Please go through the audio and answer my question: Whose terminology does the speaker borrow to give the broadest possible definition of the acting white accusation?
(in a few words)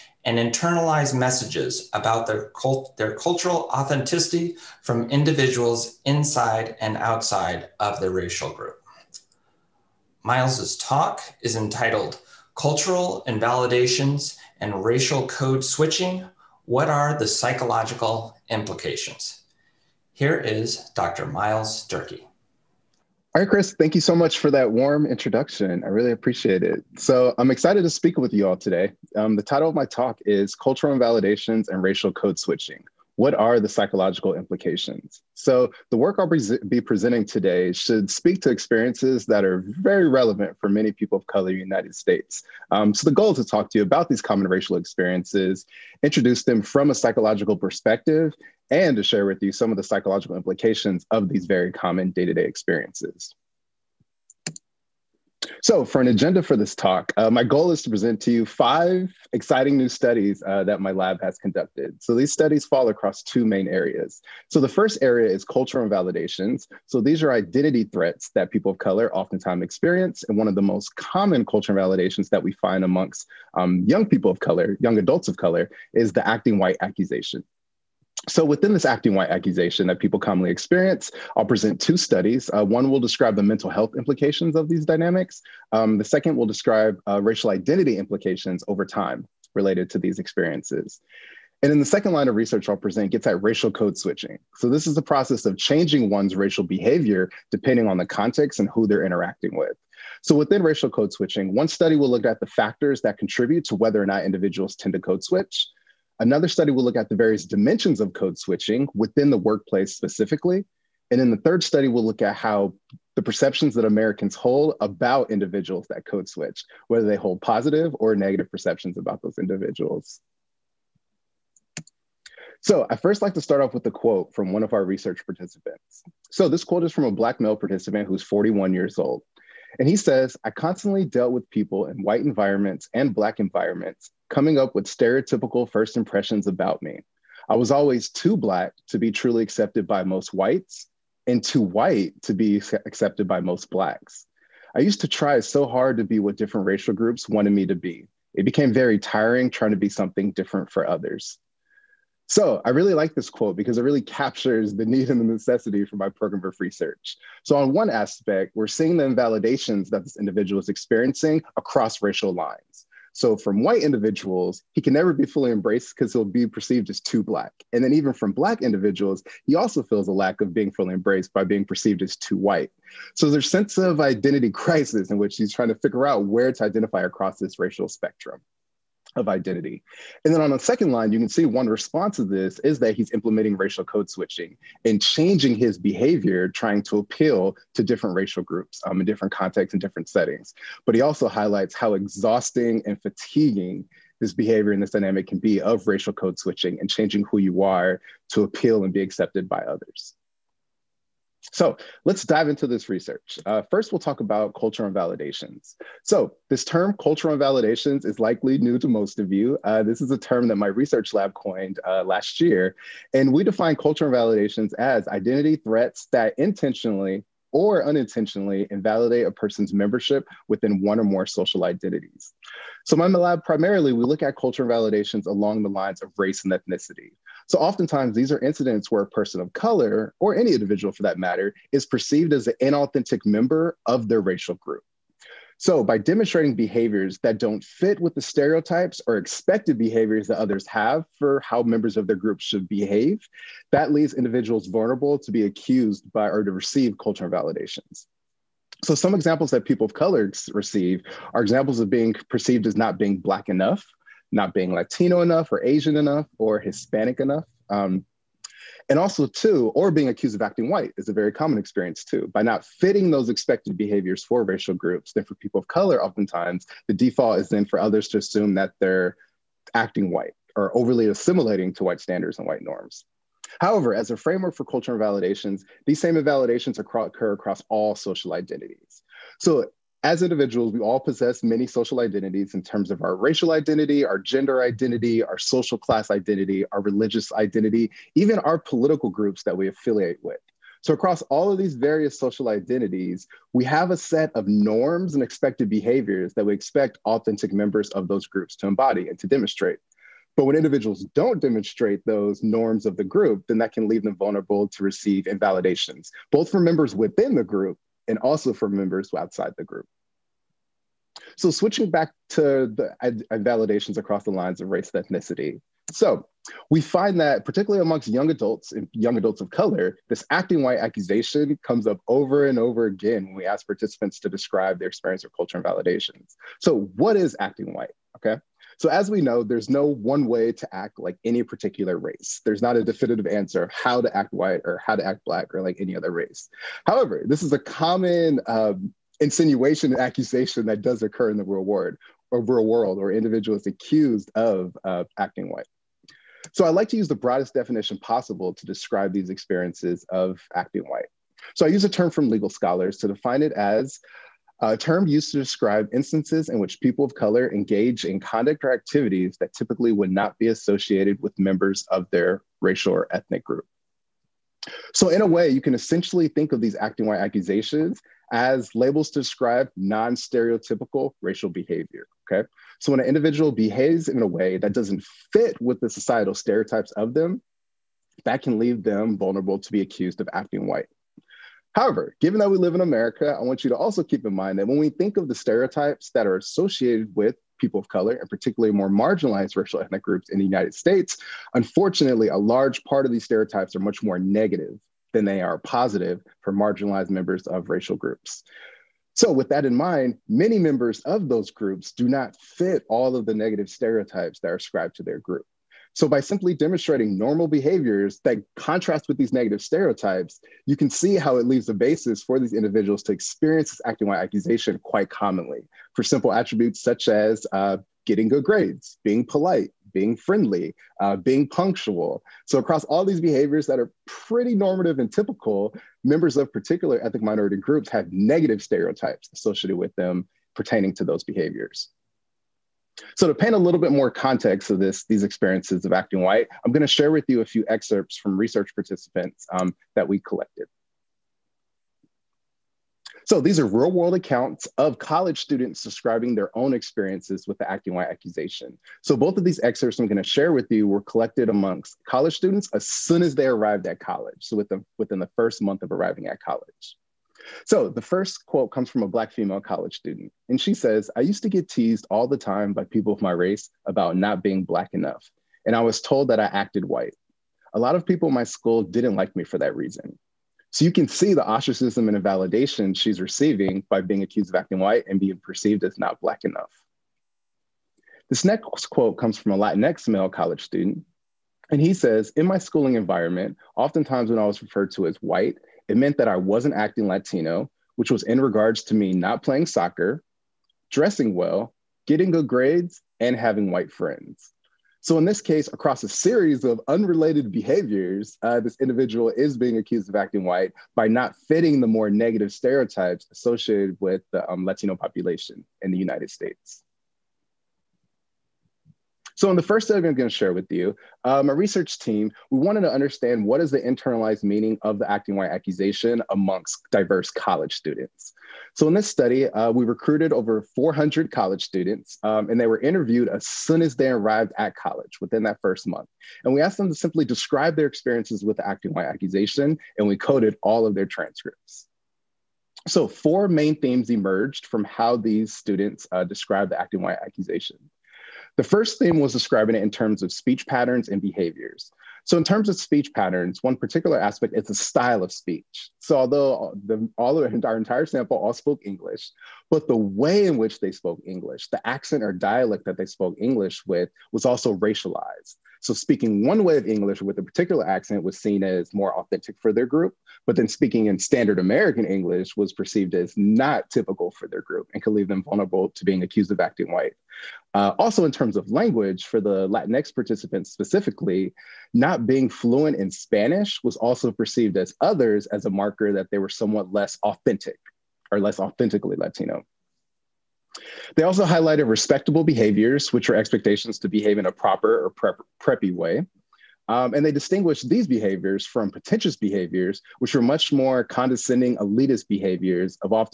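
legal scholars.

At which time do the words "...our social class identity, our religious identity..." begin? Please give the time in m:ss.
4:45.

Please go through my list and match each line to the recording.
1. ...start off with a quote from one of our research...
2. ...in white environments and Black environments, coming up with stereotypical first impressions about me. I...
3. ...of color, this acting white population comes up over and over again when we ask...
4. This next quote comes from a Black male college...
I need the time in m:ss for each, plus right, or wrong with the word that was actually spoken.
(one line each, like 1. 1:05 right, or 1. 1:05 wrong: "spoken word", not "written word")
1. 2:03 right
2. 2:11 right
3. 5:19 wrong: "accusation", not "population"
4. 7:58 wrong: "Latinx", not "Black".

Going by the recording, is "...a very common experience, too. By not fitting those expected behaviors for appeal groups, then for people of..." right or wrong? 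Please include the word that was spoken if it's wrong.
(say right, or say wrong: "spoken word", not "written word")
wrong: "racial", not "appeal".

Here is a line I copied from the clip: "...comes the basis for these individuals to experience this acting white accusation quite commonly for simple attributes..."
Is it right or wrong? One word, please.
wrong.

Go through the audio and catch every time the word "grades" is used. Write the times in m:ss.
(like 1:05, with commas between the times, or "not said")
6:58, 8:12.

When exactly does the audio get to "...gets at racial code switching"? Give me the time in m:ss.
1:33.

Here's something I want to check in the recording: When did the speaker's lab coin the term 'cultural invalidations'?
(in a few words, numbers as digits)
last year.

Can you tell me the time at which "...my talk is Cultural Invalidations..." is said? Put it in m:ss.
0:29.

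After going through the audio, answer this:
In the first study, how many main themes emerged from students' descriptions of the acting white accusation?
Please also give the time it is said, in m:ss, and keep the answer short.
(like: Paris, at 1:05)
4, at 8:53.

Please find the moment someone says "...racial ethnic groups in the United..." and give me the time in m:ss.
6:29.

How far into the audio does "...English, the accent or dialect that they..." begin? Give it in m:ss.
9:11.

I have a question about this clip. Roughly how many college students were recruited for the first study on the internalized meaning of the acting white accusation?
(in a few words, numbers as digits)
over 400.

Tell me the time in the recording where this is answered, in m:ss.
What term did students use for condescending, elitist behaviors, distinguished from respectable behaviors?
9:48.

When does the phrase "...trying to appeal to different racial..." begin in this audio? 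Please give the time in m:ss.
3:06.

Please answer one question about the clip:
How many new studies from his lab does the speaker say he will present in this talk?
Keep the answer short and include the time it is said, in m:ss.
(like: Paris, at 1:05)
5, at 0:58.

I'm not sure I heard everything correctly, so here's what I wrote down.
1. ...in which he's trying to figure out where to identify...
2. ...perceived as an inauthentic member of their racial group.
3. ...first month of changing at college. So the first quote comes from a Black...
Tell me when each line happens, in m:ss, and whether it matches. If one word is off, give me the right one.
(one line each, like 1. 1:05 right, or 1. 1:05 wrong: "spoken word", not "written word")
1. 2:55 right
2. 3:51 right
3. 7:35 wrong: "arriving", not "changing".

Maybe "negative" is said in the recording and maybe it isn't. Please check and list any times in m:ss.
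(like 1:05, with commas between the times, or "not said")
1:58, 6:34, 6:43, 6:49, 7:08, 8:22.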